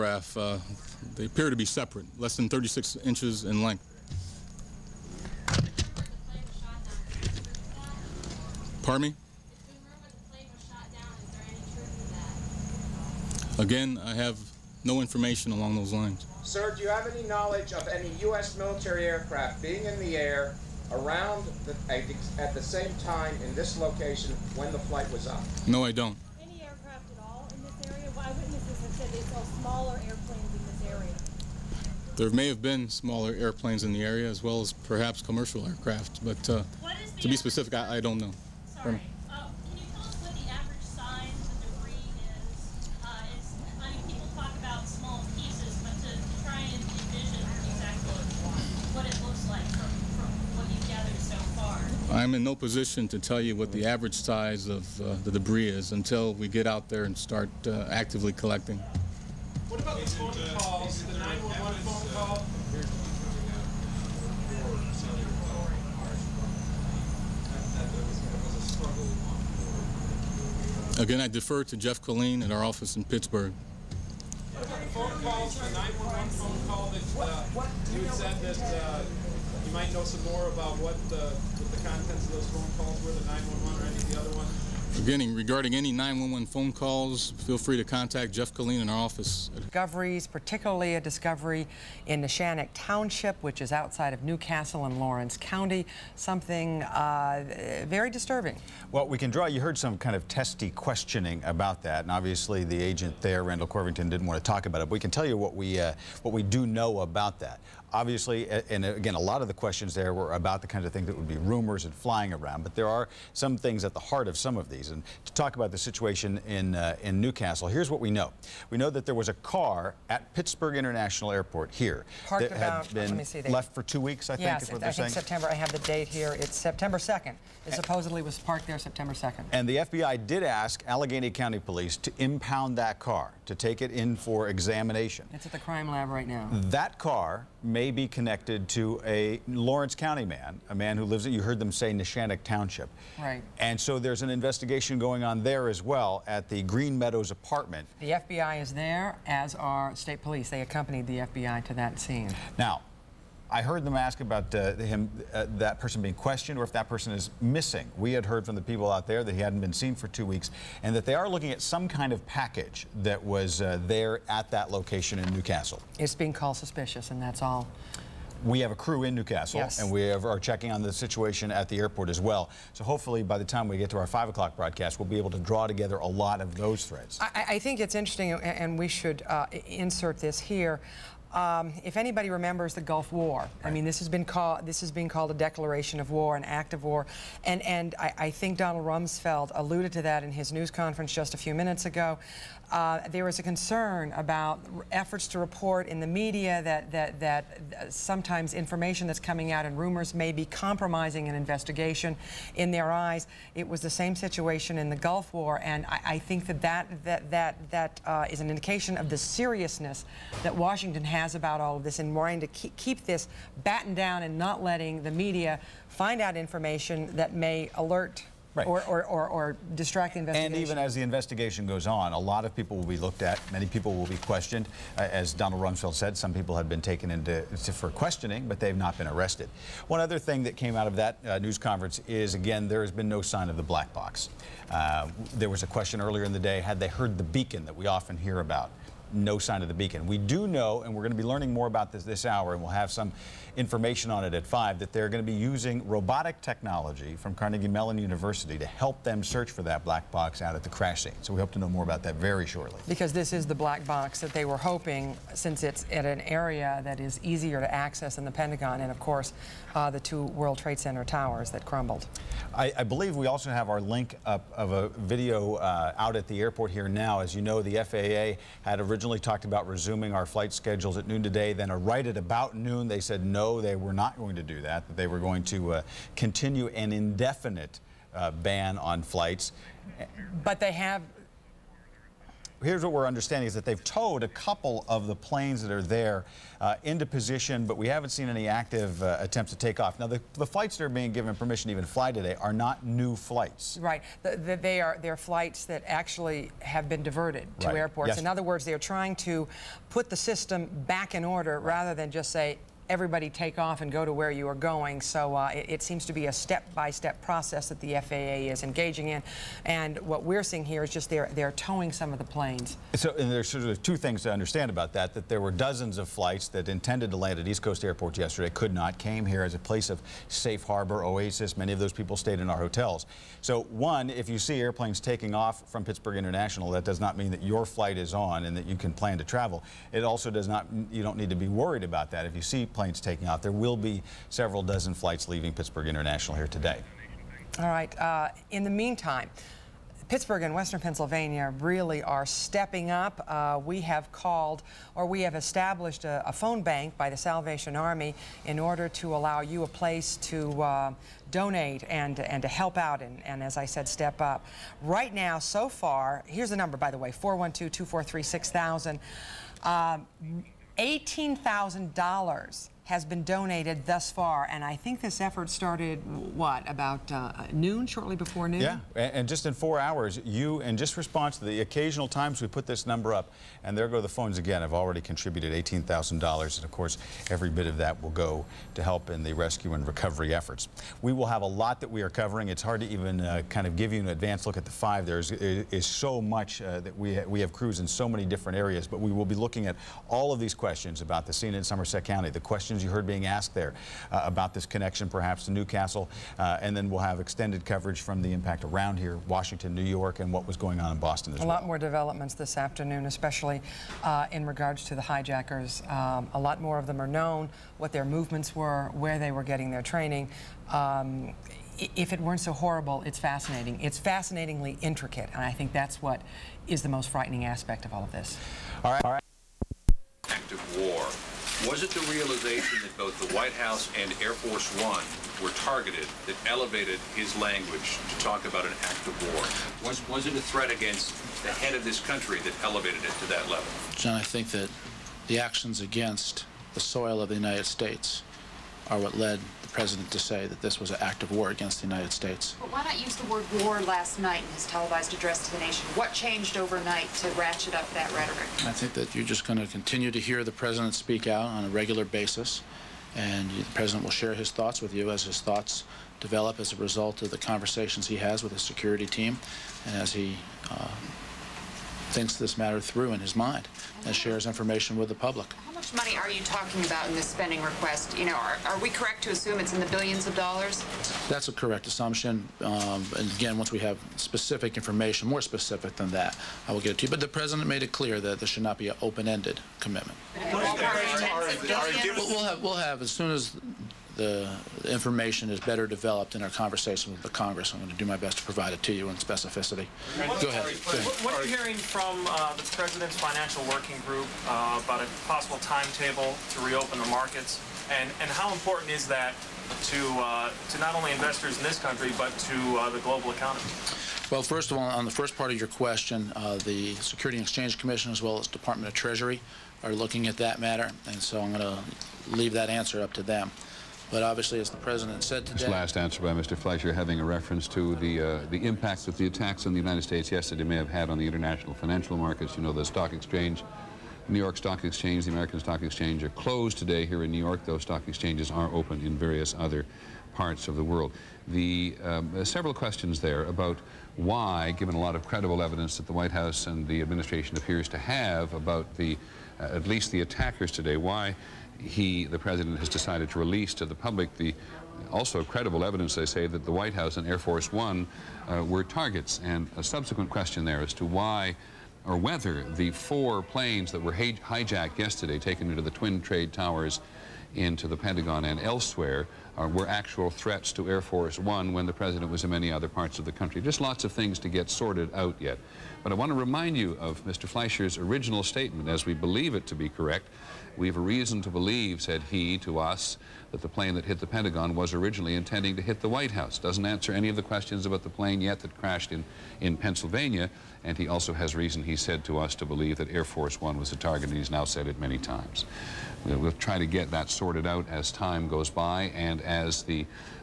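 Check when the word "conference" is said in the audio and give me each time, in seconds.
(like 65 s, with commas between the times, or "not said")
190 s, 231 s.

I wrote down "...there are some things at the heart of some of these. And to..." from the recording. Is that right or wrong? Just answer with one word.
right.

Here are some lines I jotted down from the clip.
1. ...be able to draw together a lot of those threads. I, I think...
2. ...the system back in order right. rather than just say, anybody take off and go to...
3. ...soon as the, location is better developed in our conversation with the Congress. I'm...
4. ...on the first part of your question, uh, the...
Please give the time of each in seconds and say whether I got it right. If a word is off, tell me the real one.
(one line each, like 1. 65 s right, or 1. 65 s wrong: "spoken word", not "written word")
1. 175 s right
2. 300 s wrong: "everybody", not "anybody"
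3. 483 s wrong: "information", not "location"
4. 504 s right.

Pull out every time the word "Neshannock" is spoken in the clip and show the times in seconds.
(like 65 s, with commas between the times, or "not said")
92 s, 141 s.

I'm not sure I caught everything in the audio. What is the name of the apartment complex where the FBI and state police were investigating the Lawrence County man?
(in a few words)
Green Meadows.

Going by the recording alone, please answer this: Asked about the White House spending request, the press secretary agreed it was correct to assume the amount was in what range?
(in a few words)
Billions of dollars.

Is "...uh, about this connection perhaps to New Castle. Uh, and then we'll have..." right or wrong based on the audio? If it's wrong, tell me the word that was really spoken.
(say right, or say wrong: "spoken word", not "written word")
right.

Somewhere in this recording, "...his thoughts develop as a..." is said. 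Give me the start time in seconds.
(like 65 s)
455 s.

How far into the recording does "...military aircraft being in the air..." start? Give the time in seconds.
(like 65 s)
18 s.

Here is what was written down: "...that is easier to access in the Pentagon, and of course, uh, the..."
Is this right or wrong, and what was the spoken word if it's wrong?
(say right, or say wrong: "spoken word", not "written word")
right.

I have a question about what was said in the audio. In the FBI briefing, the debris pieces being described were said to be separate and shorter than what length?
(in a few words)
36 inches.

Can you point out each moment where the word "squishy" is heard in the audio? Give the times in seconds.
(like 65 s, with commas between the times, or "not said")
not said.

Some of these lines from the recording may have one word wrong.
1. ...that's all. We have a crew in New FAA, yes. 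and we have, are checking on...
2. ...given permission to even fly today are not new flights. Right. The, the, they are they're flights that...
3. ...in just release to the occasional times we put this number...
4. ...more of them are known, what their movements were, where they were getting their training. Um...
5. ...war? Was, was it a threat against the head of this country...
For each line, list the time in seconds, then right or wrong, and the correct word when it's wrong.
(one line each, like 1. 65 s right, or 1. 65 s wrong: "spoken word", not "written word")
1. 167 s wrong: "Castle", not "FAA"
2. 291 s right
3. 370 s wrong: "response", not "release"
4. 406 s right
5. 429 s right.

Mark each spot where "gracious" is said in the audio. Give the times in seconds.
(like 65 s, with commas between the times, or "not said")
not said.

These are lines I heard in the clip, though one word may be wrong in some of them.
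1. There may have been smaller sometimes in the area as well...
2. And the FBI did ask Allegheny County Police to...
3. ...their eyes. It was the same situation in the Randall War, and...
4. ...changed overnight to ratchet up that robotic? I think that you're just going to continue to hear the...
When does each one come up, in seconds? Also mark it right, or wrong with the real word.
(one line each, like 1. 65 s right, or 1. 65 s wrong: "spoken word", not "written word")
1. 32 s wrong: "airplanes", not "sometimes"
2. 129 s right
3. 202 s wrong: "Gulf", not "Randall"
4. 446 s wrong: "rhetoric", not "robotic".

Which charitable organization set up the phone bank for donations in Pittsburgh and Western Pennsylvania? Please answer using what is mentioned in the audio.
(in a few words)
Salvation Army.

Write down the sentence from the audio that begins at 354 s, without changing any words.
Right now, so far, here's the number, by the way, 412-243-6000, um, $18,000 has been donated thus far.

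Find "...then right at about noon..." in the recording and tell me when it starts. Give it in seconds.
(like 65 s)
271 s.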